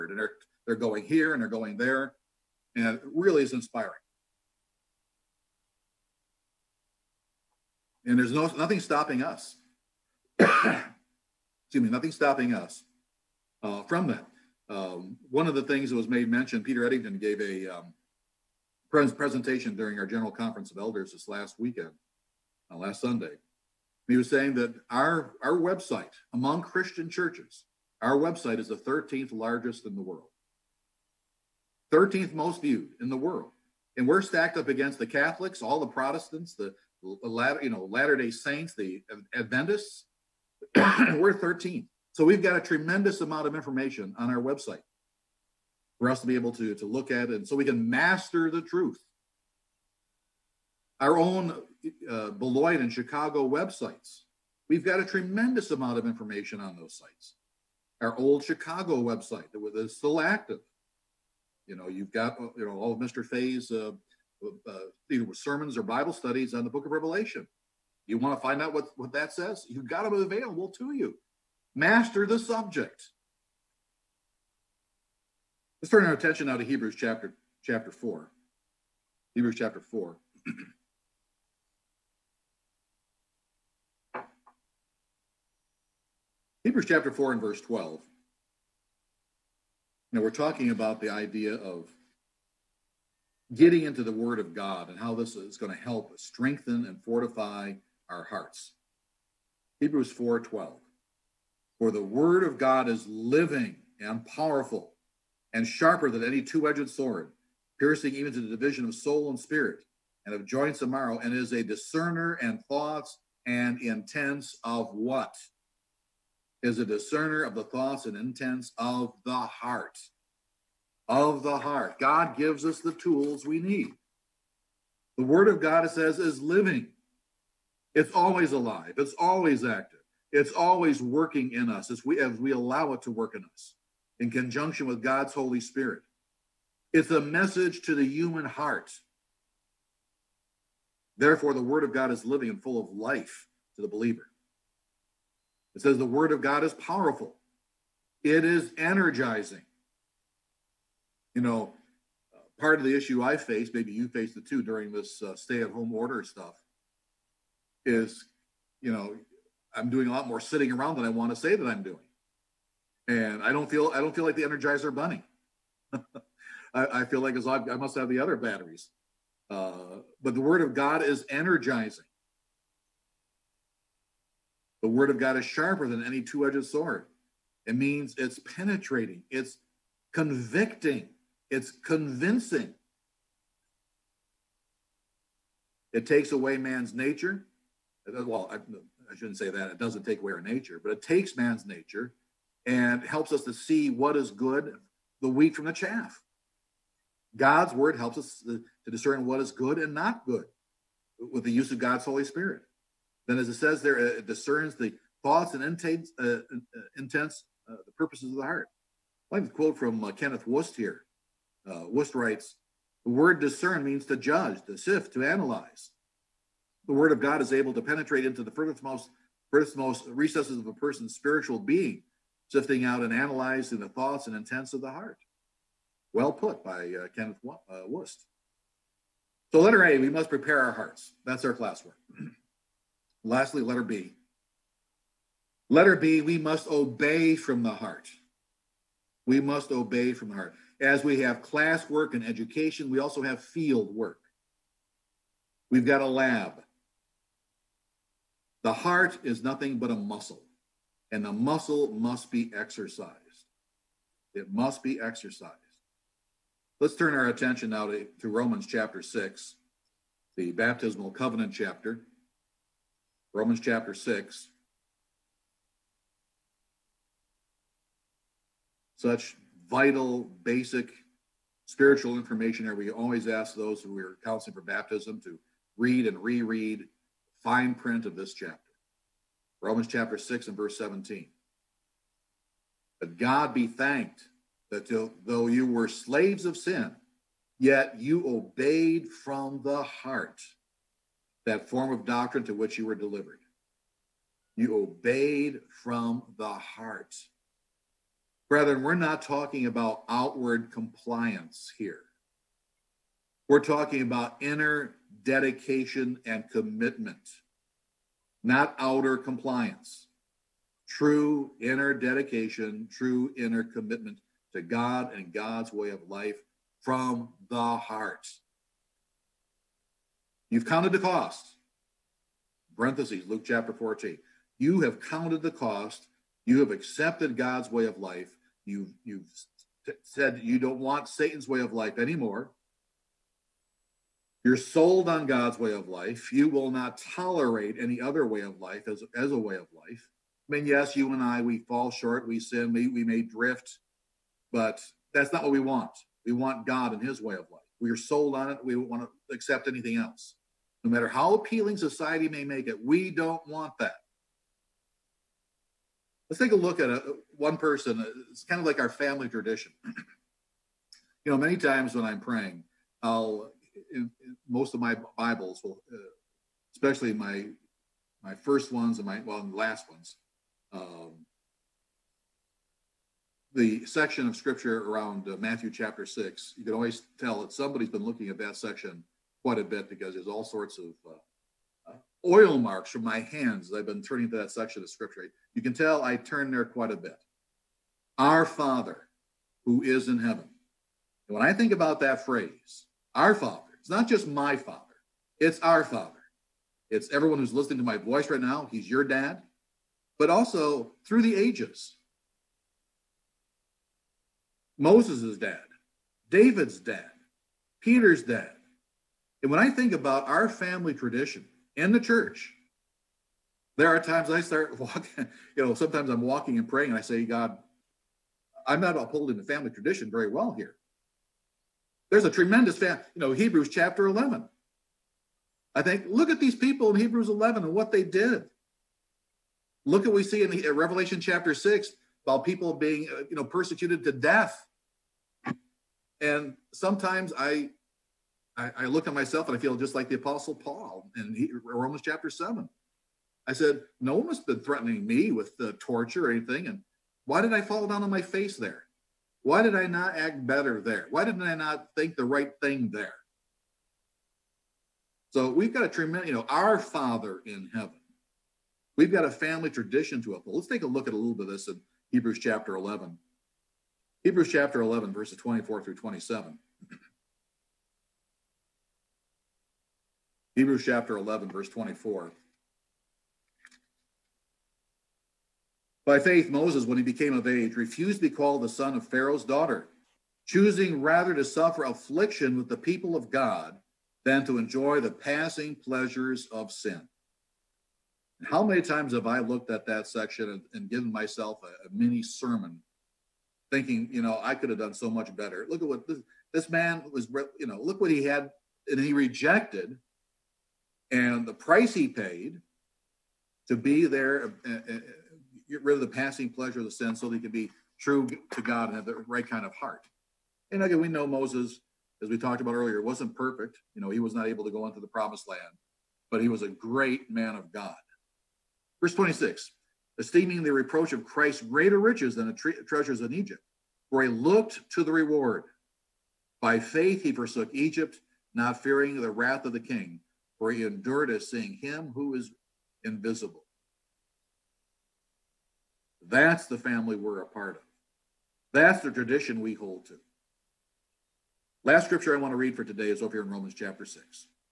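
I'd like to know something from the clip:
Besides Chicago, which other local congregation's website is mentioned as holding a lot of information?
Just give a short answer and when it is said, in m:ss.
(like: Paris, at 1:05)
Beloit, at 0:52.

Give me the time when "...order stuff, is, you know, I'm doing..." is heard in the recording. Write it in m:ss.
2:35.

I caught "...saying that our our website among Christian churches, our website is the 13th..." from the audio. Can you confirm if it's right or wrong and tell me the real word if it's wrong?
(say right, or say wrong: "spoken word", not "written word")
right.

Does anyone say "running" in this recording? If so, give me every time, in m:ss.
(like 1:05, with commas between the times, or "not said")
not said.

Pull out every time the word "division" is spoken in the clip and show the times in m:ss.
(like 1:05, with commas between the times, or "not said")
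1:48.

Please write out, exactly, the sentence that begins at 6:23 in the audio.
I've been turning to that section of scripture.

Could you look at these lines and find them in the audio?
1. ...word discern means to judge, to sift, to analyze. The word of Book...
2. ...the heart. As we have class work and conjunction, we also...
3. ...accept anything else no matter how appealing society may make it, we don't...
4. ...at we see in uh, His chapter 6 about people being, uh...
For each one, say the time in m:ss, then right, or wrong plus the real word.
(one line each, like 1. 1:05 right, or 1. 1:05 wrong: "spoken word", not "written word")
1. 3:33 wrong: "God", not "Book"
2. 4:00 wrong: "education", not "conjunction"
3. 5:49 right
4. 7:10 wrong: "Revelation", not "His".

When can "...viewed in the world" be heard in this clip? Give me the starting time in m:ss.
0:32.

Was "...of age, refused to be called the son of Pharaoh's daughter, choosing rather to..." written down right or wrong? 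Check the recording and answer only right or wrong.
right.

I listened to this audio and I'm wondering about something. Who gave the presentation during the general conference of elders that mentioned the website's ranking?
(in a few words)
Peter Eddington.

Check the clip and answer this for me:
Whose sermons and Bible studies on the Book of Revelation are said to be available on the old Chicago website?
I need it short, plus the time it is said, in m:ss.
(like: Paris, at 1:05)
Mr. Fay, at 1:02.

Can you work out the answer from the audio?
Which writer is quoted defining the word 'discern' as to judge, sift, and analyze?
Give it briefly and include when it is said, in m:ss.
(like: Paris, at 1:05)
Kenneth Wust, at 3:30.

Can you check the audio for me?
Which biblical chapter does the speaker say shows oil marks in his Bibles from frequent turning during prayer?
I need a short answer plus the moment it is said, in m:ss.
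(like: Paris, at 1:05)
Matthew 6, at 6:15.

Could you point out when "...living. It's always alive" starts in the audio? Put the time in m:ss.
2:06.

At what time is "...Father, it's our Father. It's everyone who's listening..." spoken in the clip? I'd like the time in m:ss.
6:34.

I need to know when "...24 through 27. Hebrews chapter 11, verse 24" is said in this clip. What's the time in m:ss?
7:45.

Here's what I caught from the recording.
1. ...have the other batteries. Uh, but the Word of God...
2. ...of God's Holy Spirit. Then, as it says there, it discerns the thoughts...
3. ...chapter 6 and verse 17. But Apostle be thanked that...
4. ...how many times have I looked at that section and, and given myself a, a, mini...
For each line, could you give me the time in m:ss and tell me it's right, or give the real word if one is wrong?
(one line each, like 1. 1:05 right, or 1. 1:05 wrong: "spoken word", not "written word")
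1. 2:47 right
2. 3:21 right
3. 4:39 wrong: "God", not "Apostle"
4. 8:08 right.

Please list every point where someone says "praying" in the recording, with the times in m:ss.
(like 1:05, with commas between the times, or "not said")
6:02, 6:56.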